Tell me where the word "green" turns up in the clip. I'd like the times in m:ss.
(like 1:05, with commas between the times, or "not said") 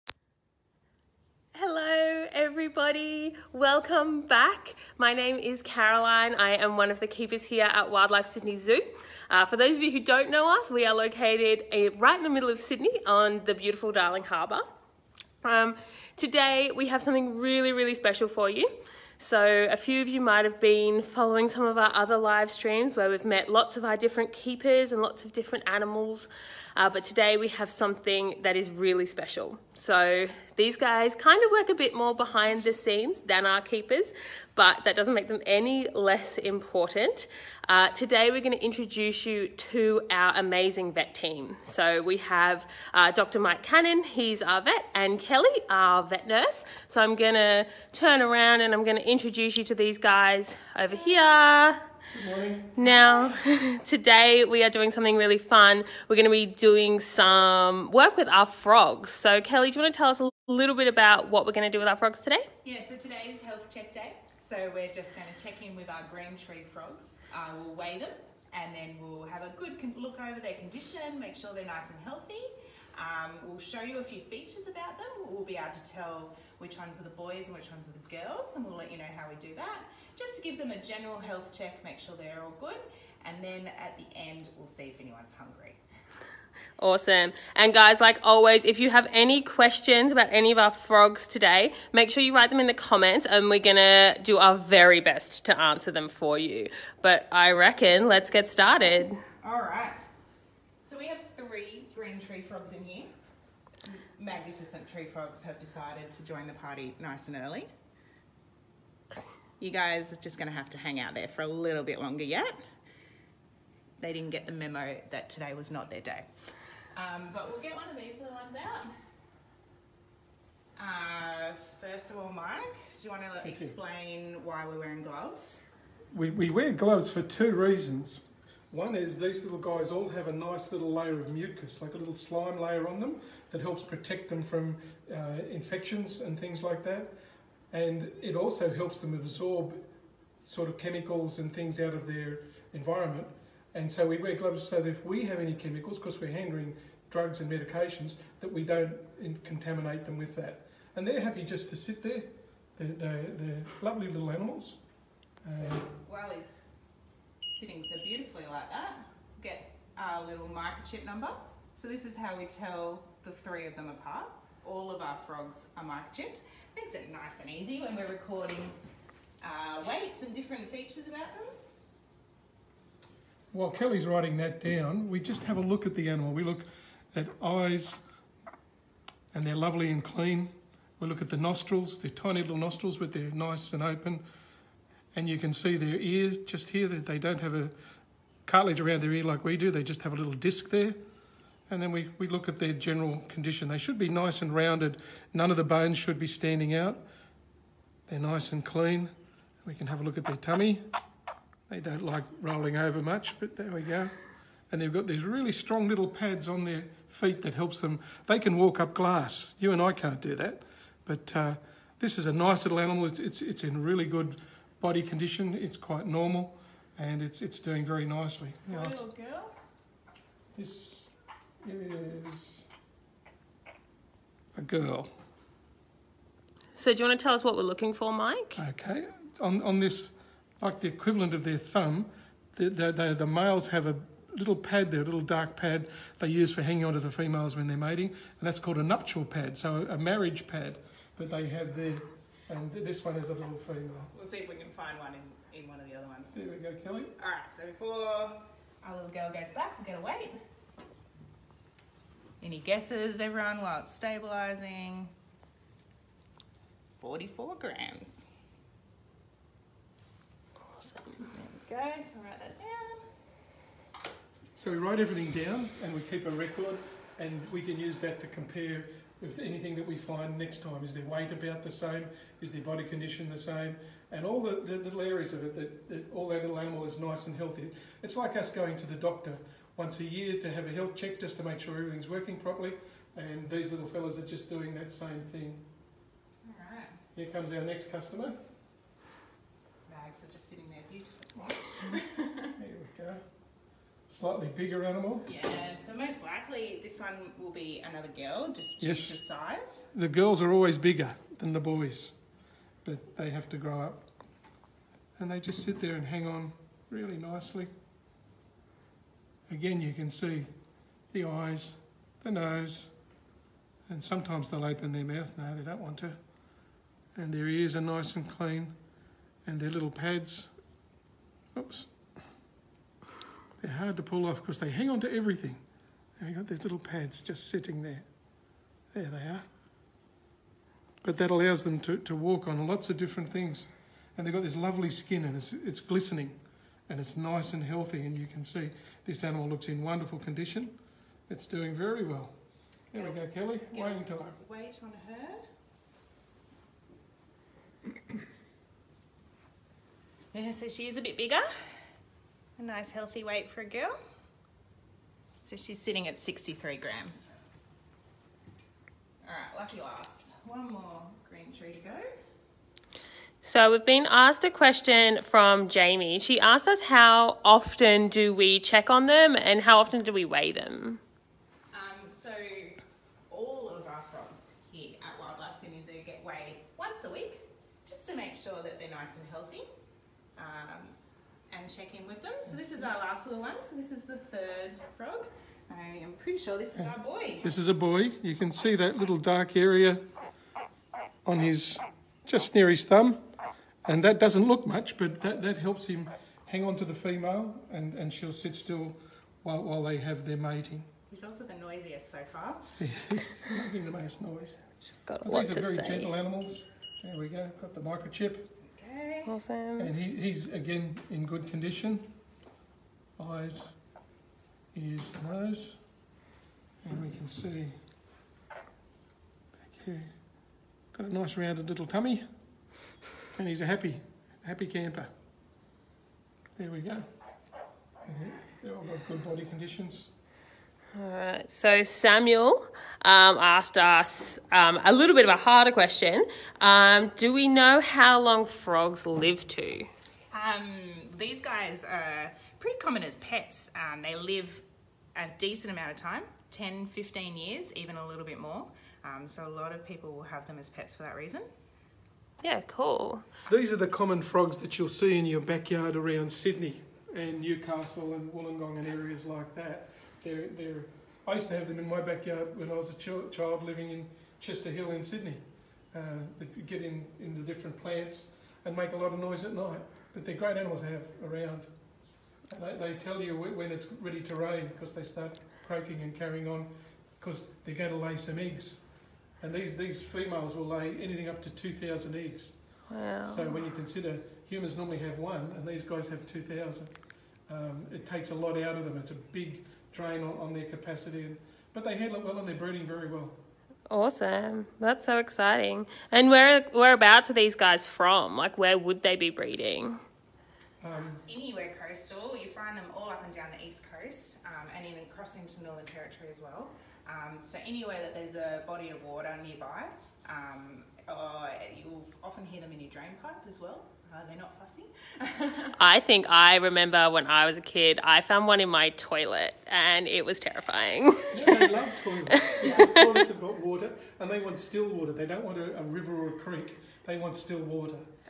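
1:06, 1:41, 6:01.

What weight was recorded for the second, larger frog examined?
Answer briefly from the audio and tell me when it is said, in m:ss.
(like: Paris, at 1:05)
63 grams, at 5:56.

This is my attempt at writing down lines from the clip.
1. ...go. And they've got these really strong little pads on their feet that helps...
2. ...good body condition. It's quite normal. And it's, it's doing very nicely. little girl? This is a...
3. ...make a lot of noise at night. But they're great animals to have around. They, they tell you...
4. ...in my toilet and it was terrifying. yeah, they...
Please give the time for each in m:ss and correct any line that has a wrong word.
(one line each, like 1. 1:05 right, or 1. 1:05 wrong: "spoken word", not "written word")
1. 3:23 right
2. 3:34 right
3. 7:48 right
4. 8:38 right.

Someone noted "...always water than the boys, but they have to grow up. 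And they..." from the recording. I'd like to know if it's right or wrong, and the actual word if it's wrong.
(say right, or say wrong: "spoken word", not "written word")
wrong: "bigger", not "water".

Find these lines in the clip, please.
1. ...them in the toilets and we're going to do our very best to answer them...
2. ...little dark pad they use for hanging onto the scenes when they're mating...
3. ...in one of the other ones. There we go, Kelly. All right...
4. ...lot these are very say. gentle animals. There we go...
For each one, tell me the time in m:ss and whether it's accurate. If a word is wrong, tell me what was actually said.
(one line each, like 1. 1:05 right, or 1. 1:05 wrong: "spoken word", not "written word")
1. 1:32 wrong: "comments", not "toilets"
2. 3:55 wrong: "females", not "scenes"
3. 4:05 right
4. 6:45 right.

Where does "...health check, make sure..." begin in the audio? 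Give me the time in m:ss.
1:21.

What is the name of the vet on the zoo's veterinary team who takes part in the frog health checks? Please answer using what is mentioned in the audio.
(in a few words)
Dr. Mike Cannon.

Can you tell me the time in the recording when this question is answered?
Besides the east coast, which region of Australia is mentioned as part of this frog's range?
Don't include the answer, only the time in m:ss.
8:25.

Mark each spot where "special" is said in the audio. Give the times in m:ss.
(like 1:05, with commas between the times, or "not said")
0:17, 0:29.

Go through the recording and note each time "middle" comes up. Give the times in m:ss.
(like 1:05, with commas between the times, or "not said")
0:12.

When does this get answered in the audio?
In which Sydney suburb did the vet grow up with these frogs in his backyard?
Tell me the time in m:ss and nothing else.
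7:44.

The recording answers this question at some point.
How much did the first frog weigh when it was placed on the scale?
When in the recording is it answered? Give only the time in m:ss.
4:17.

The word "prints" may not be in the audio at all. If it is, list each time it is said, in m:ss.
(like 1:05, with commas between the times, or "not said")
not said.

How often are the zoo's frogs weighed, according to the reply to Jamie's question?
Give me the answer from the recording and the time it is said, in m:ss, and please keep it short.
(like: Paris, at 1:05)
once a week, at 6:16.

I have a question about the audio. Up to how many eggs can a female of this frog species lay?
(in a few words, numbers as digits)
2,000.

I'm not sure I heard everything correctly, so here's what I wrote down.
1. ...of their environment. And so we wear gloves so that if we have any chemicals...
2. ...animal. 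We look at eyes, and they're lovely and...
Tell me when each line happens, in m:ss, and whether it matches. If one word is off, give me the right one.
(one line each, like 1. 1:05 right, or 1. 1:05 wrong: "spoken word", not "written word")
1. 2:21 right
2. 2:56 right.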